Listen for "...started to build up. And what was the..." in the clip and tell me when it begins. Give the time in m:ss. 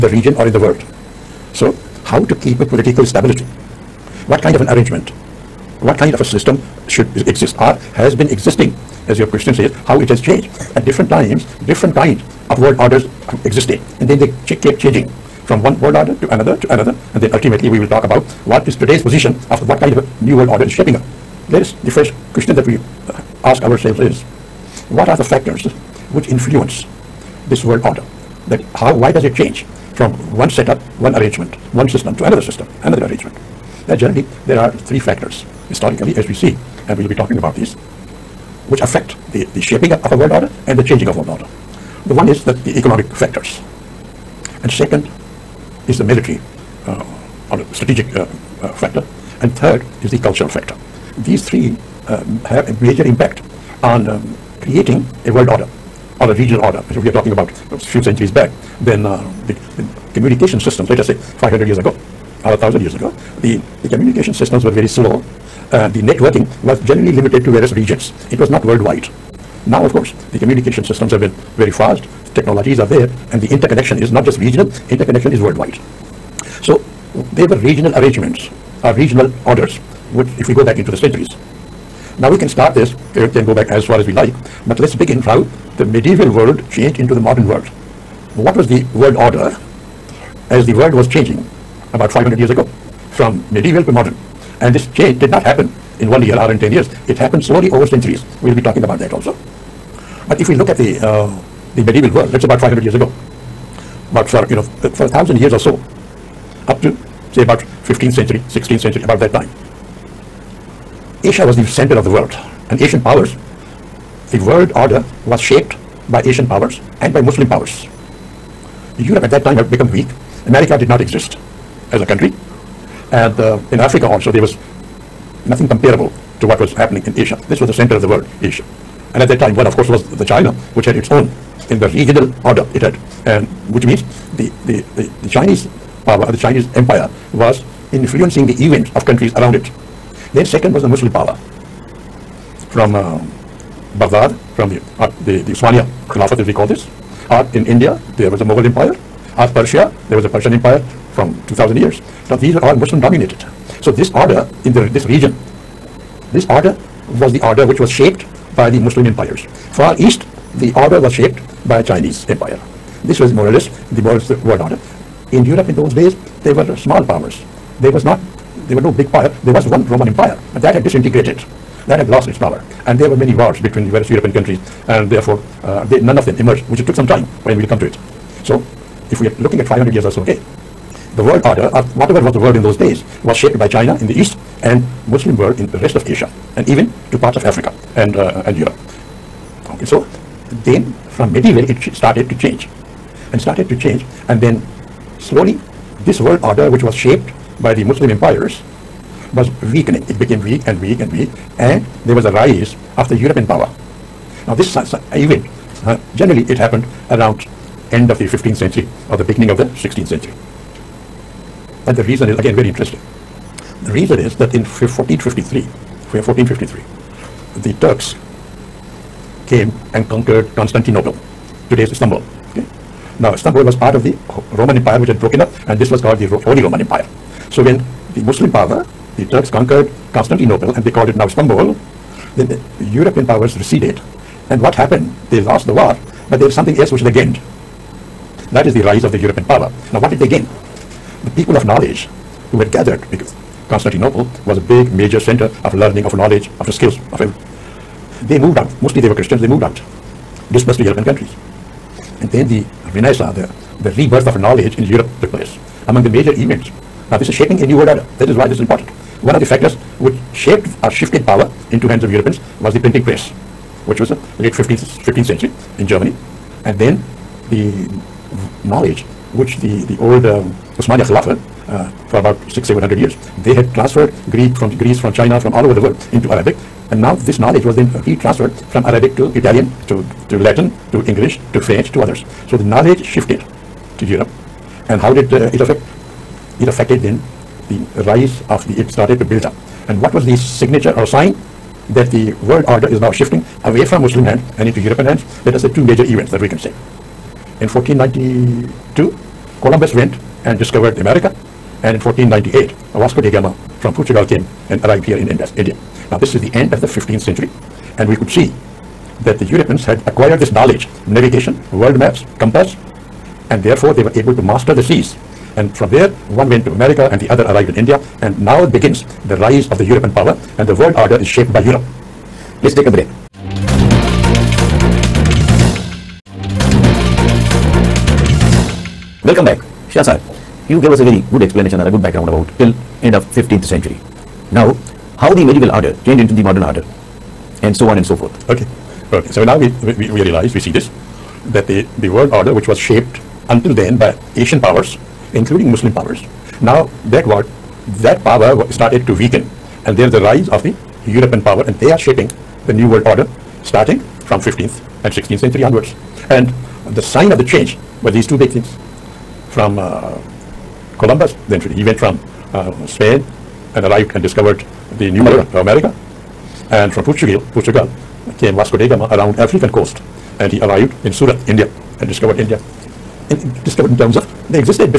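4:48.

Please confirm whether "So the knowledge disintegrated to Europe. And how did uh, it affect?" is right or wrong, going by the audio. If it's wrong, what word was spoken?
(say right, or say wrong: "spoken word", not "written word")
wrong: "shifted", not "disintegrated".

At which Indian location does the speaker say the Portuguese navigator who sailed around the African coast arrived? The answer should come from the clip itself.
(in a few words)
Surat.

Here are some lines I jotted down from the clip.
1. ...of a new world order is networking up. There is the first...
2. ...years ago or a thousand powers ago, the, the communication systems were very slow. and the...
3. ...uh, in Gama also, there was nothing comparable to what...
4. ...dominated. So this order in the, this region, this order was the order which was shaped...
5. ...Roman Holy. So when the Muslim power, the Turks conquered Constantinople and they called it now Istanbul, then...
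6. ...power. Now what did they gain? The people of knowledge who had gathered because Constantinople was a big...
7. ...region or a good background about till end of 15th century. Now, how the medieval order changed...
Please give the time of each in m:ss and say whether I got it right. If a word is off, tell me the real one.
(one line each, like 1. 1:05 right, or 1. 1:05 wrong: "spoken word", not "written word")
1. 0:19 wrong: "shaping", not "networking"
2. 1:01 wrong: "years", not "powers"
3. 2:03 wrong: "Africa", not "Gama"
4. 2:33 right
5. 3:46 wrong: "Empire", not "Holy"
6. 3:59 right
7. 5:31 wrong: "explanation", not "region".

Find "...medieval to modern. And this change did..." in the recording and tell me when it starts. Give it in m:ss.
1:33.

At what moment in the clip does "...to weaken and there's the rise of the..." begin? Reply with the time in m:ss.
5:49.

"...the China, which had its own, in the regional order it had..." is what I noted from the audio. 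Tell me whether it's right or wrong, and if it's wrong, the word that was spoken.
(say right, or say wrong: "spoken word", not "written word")
right.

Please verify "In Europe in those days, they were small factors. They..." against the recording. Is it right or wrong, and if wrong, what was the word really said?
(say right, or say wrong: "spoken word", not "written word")
wrong: "powers", not "factors".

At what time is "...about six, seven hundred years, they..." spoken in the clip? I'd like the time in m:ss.
4:32.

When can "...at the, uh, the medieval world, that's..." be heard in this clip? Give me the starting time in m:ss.
1:40.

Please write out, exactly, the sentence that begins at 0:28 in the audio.
That how, why does it change from one setup, one arrangement, one system to another system, another arrangement?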